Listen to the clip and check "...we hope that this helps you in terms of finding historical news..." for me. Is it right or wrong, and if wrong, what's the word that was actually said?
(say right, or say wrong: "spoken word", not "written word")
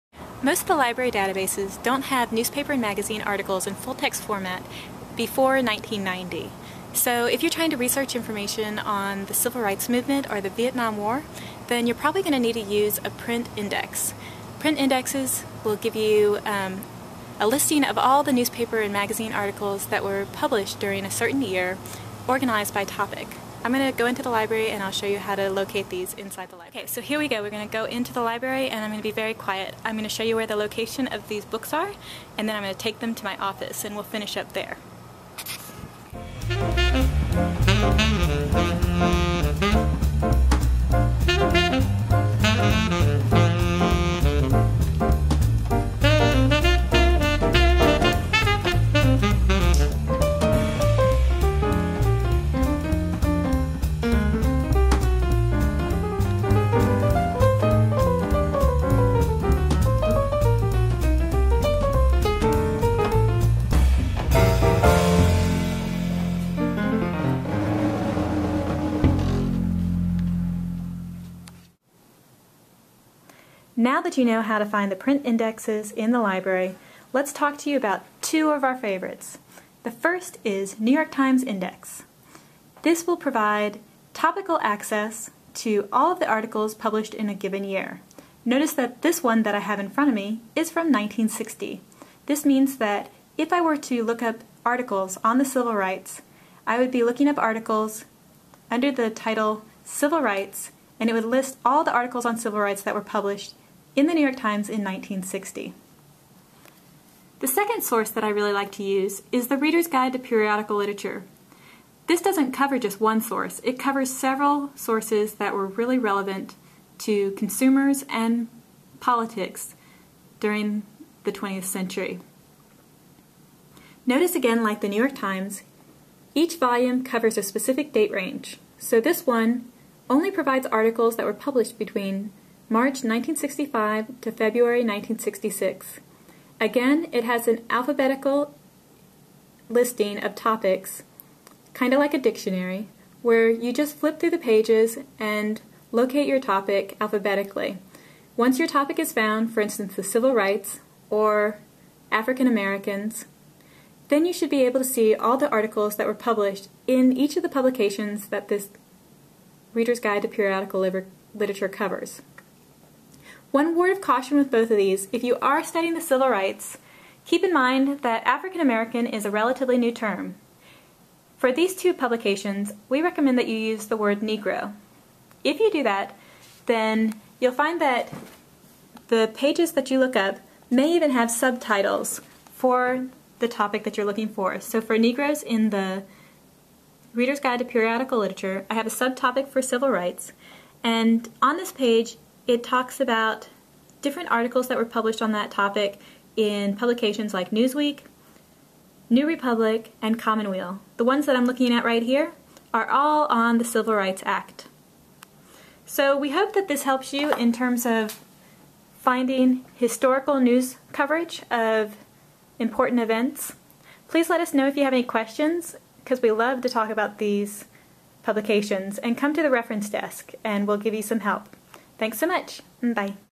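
right.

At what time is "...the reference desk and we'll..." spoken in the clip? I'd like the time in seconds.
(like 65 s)
219 s.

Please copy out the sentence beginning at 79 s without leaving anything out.
The first is New York Times Index.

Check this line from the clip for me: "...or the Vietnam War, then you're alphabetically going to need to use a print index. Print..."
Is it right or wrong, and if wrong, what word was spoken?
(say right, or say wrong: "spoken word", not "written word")
wrong: "probably", not "alphabetically".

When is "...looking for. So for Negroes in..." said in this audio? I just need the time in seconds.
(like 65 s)
184 s.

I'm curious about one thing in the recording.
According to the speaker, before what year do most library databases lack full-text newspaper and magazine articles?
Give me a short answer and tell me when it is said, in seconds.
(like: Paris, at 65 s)
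1990, at 5 s.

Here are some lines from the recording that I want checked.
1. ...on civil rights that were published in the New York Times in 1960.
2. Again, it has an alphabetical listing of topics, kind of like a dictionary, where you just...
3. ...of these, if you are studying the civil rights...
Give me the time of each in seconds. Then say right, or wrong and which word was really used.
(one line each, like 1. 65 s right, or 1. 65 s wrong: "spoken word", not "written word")
1. 102 s right
2. 136 s right
3. 164 s right.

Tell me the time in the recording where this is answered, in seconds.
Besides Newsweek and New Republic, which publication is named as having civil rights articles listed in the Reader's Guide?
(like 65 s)
200 s.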